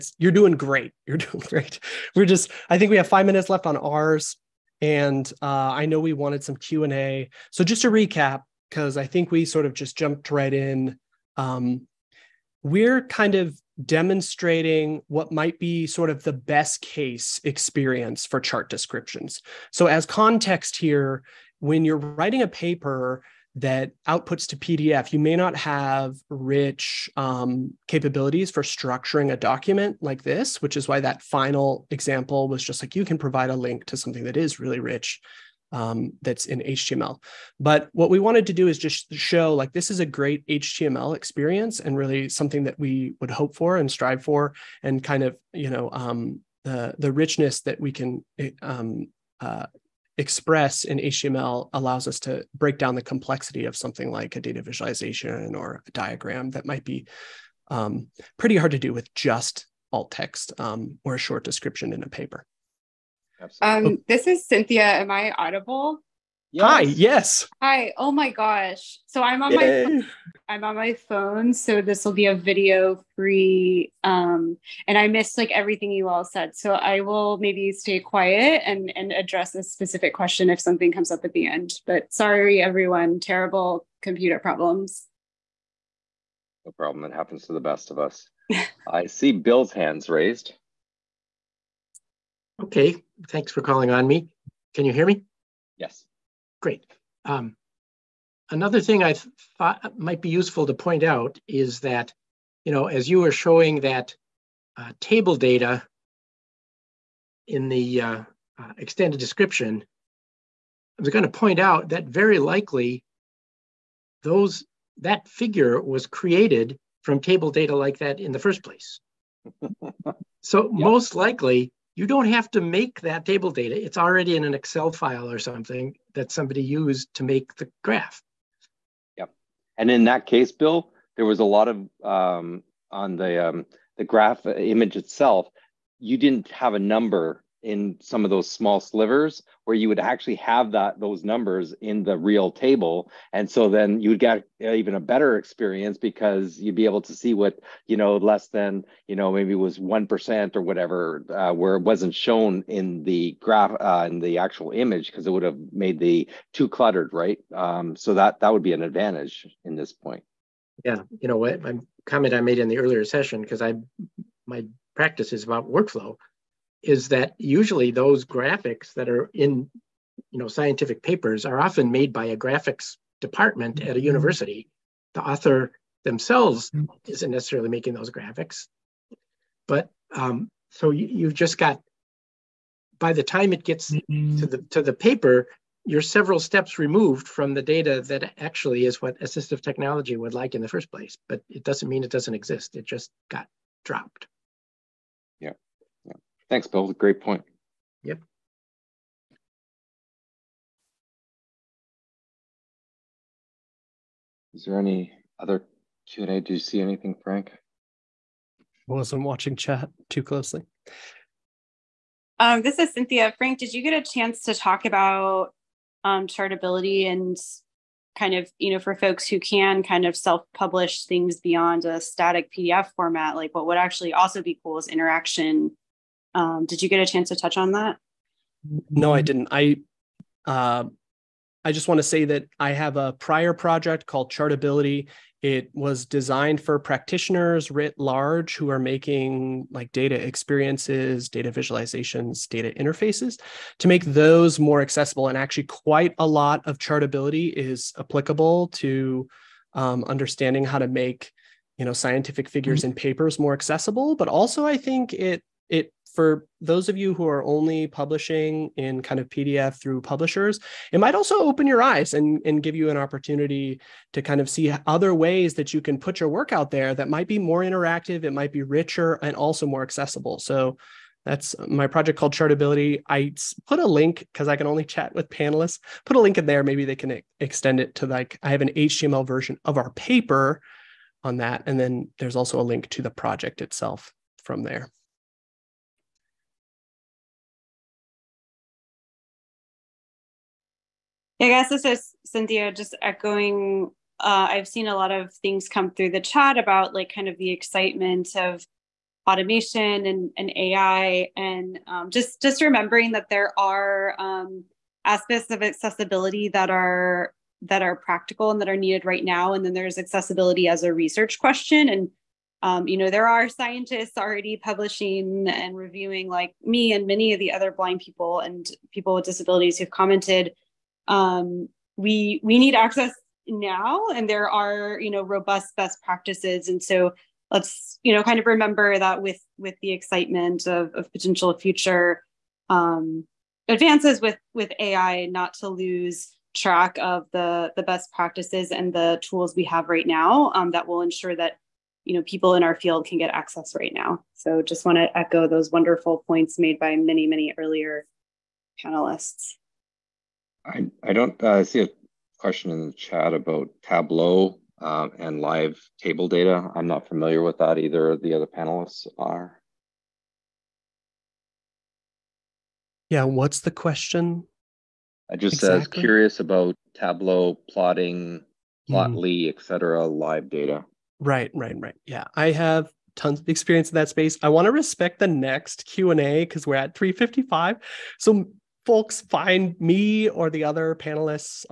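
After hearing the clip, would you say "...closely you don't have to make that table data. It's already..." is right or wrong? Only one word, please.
wrong.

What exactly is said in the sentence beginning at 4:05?
And actually, quite a lot of Chartability is applicable to um, understanding how to make you know scientific figures and mm-hmm.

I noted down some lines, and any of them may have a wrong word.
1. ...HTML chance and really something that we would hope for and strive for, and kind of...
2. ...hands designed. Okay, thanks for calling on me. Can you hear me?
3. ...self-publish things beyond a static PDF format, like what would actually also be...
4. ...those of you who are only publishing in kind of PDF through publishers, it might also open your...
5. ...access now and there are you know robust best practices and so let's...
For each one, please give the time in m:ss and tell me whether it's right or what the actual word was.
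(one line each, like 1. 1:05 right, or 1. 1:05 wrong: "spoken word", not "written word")
1. 0:40 wrong: "experience", not "chance"
2. 1:29 wrong: "raised", not "designed"
3. 3:40 right
4. 4:16 right
5. 5:22 right.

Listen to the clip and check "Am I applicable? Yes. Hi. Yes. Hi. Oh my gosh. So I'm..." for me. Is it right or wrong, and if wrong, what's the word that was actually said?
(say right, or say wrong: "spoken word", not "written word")
wrong: "audible", not "applicable".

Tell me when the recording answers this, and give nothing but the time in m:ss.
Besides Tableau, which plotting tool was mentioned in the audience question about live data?
6:08.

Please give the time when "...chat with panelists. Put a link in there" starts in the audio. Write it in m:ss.
4:34.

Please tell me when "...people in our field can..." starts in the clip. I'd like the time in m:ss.
5:42.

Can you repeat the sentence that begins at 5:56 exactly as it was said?
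I'm not familiar with that either.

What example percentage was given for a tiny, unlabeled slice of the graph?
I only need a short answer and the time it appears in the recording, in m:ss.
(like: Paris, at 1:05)
1%, at 2:29.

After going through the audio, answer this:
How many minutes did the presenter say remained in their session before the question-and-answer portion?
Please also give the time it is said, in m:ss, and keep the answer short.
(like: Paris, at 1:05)
5, at 0:03.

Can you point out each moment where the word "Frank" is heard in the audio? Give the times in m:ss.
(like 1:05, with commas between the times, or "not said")
3:27, 3:33.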